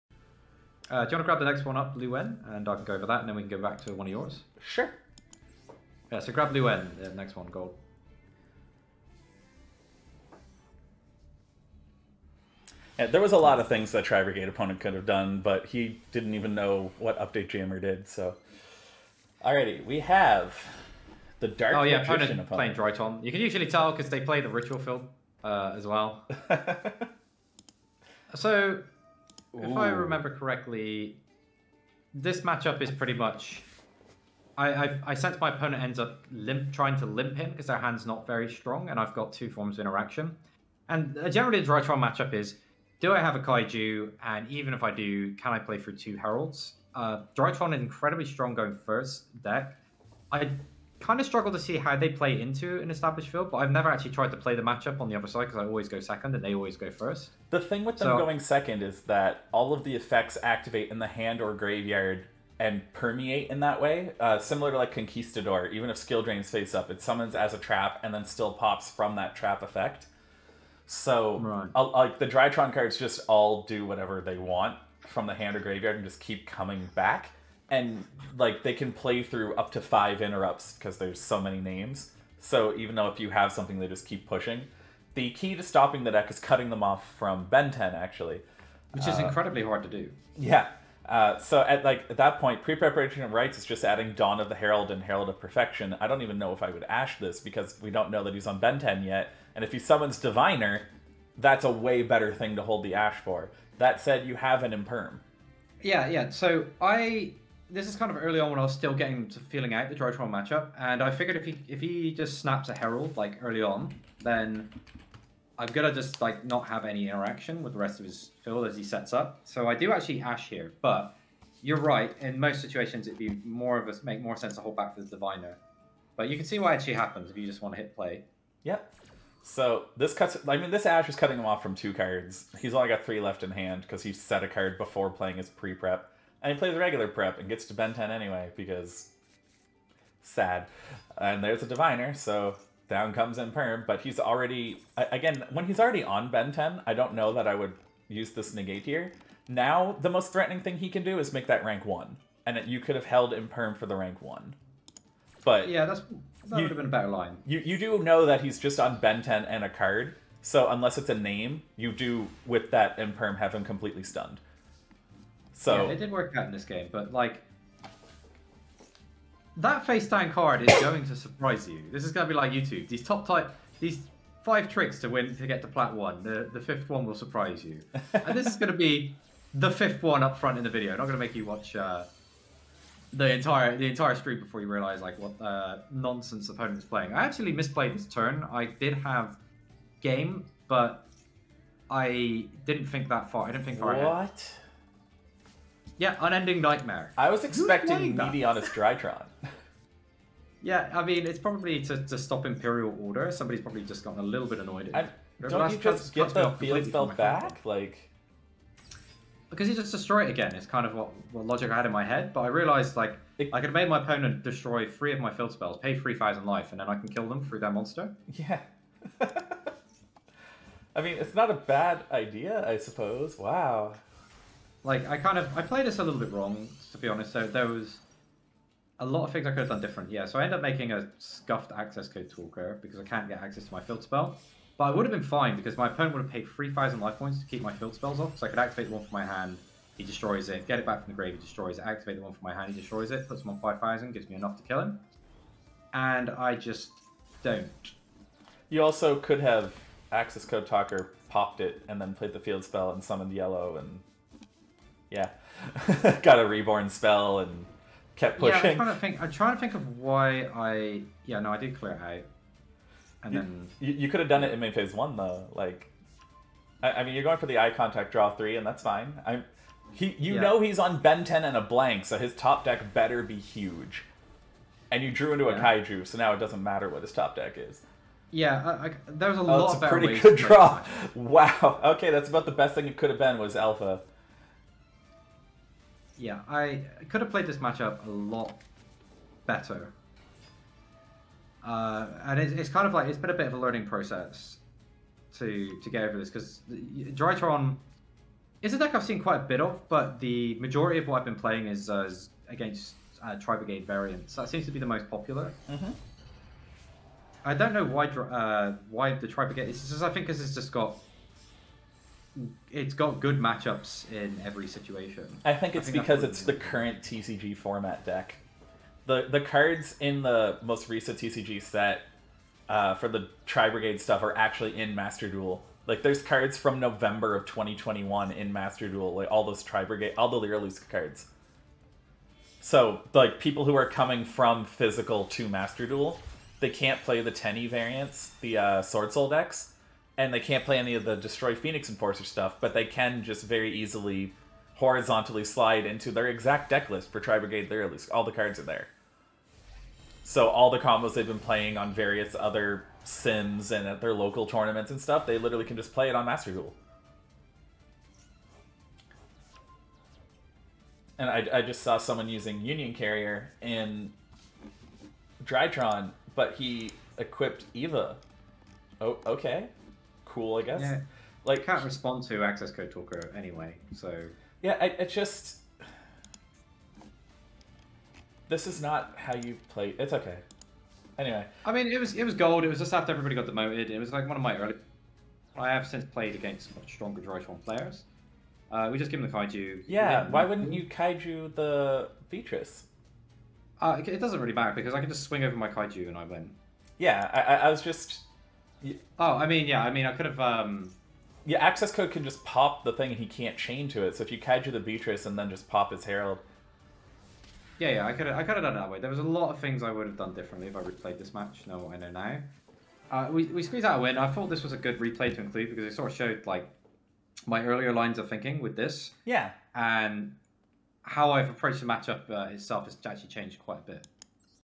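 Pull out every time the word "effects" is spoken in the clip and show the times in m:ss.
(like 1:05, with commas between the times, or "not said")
0:59, 1:09.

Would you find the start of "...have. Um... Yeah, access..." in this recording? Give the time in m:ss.
6:40.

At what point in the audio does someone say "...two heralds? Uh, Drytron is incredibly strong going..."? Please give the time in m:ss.
0:45.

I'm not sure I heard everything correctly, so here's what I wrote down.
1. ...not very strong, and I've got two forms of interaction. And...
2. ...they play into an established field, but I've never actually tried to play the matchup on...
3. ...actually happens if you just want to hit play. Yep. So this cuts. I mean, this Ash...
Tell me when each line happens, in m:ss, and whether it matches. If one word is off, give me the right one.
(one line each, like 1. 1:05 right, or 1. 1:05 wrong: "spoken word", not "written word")
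1. 0:38 right
2. 0:51 right
3. 2:06 right.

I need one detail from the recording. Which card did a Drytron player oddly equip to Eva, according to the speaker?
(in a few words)
Union Carrier.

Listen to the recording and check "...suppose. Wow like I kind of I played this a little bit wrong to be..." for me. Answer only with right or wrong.
right.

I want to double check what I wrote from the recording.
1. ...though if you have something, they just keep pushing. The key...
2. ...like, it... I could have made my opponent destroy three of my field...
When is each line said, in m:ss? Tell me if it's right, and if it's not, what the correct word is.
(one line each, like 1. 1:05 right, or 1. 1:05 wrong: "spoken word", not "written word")
1. 1:22 right
2. 3:32 right.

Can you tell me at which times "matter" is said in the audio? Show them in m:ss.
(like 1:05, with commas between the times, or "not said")
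4:36, 6:34.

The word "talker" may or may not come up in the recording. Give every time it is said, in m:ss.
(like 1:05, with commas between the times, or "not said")
3:52, 4:10, 6:12.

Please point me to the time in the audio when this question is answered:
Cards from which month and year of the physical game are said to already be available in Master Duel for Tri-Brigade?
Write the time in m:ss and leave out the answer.
5:26.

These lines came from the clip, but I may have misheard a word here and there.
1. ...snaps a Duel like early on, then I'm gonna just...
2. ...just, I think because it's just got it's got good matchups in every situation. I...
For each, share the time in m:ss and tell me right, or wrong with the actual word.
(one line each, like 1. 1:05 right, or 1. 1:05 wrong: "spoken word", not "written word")
1. 1:52 wrong: "Herald", not "Duel"
2. 5:09 right.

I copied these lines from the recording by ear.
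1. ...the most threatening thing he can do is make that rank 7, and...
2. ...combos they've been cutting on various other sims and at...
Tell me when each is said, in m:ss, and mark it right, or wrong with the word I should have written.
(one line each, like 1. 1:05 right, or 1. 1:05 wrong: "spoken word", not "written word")
1. 2:30 wrong: "1", not "7"
2. 5:50 wrong: "playing", not "cutting".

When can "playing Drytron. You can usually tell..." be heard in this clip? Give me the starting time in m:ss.
0:22.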